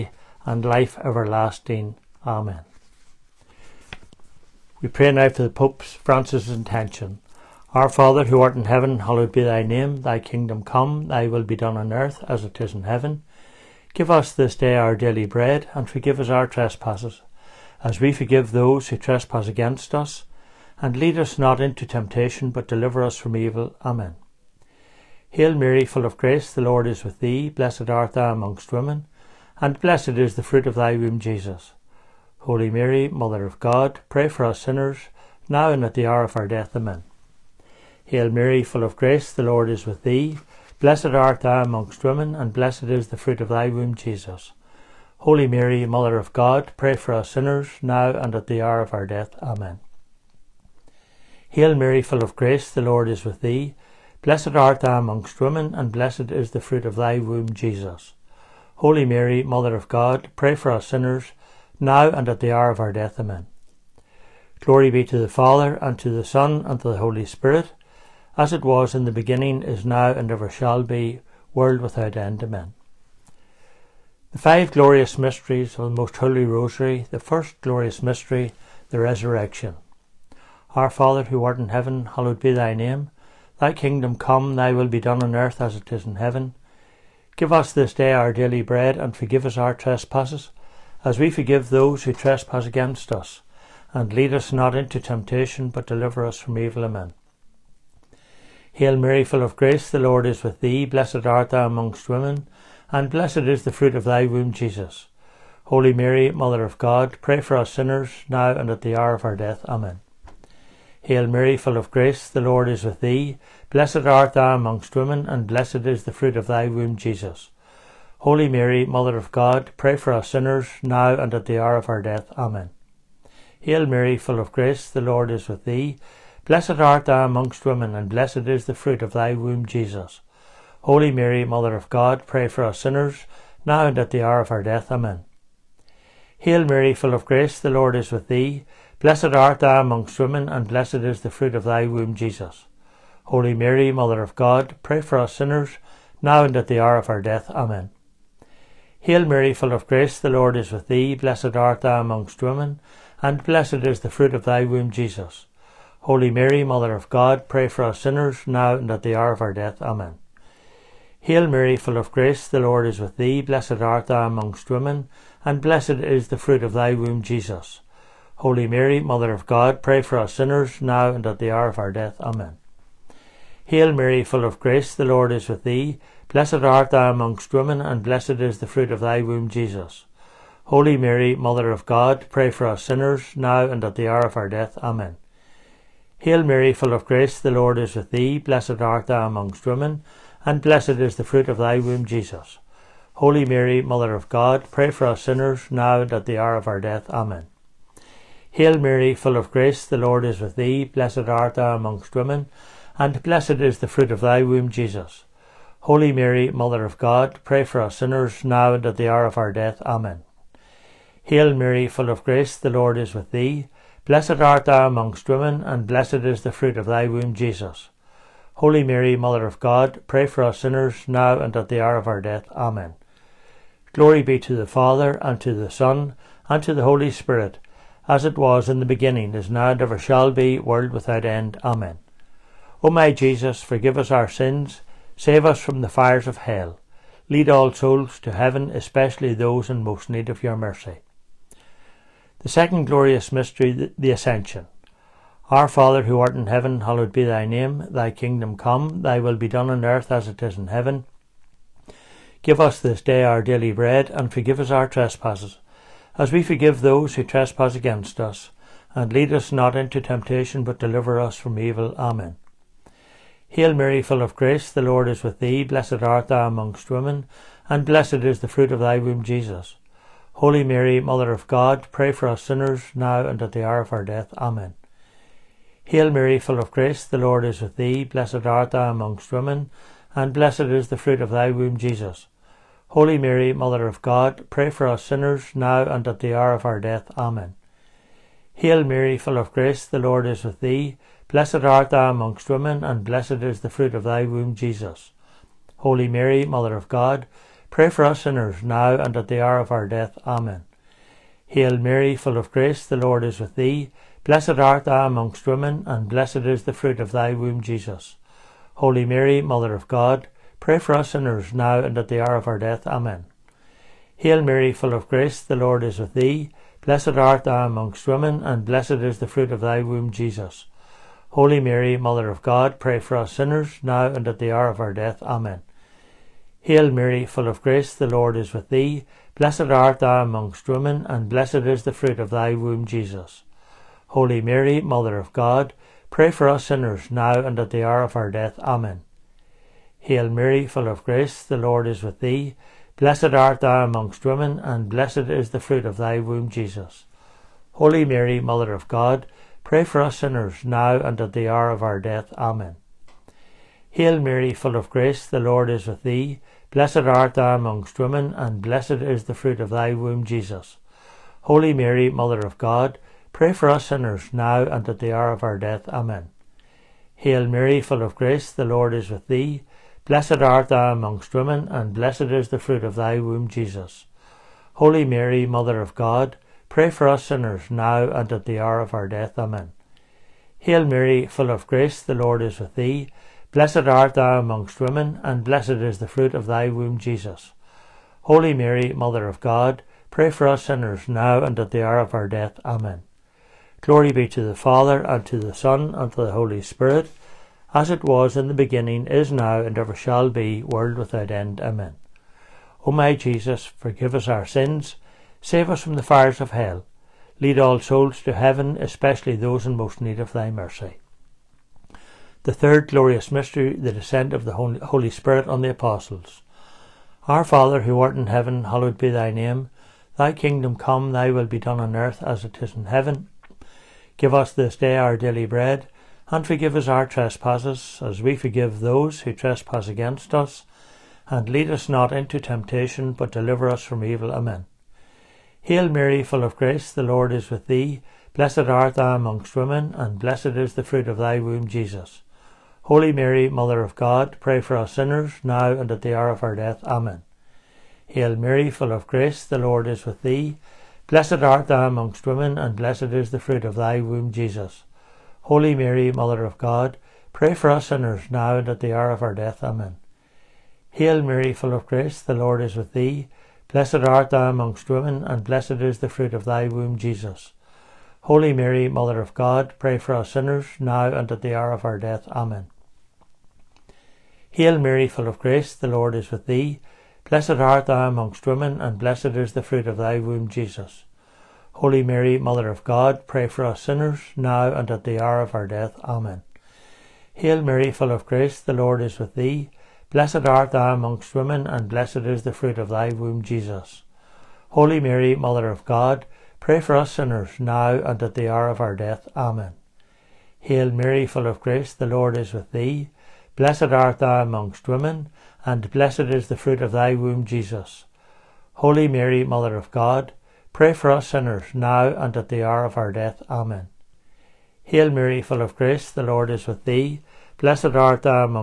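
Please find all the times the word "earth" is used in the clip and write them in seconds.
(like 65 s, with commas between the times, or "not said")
11 s, 85 s, 249 s, 421 s.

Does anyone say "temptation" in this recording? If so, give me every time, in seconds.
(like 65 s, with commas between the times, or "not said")
21 s, 94 s, 260 s, 432 s.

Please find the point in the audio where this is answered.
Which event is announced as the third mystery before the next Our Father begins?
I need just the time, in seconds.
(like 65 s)
413 s.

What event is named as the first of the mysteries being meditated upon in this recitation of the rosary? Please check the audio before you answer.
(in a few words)
The Resurrection.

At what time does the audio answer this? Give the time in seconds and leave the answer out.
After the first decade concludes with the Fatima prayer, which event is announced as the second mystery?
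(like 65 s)
243 s.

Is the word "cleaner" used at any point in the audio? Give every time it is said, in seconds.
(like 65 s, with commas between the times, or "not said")
not said.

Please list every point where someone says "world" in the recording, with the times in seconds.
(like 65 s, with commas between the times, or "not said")
71 s, 230 s, 400 s.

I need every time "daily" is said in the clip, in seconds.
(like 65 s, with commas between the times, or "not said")
14 s, 88 s, 253 s, 425 s.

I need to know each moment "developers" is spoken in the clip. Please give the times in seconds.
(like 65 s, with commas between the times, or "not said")
not said.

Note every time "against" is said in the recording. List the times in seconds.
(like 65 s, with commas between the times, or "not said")
19 s, 92 s, 257 s, 429 s.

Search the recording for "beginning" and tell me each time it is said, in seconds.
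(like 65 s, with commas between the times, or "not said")
69 s, 228 s, 398 s.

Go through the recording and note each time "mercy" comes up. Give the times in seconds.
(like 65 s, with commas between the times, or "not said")
240 s, 410 s.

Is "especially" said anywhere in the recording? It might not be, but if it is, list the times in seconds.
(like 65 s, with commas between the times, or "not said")
238 s, 408 s.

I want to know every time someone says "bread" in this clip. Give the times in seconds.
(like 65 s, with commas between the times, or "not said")
15 s, 88 s, 253 s, 425 s.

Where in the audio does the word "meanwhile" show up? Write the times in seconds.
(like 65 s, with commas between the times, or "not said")
not said.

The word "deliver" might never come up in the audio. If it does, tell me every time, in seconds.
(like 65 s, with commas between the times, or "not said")
22 s, 95 s, 260 s, 433 s.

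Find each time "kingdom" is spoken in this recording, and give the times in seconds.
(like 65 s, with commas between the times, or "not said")
10 s, 83 s, 248 s, 420 s.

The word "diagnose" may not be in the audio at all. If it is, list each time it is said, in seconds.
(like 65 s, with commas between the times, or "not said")
not said.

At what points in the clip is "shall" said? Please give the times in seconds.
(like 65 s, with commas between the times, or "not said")
70 s, 229 s, 399 s.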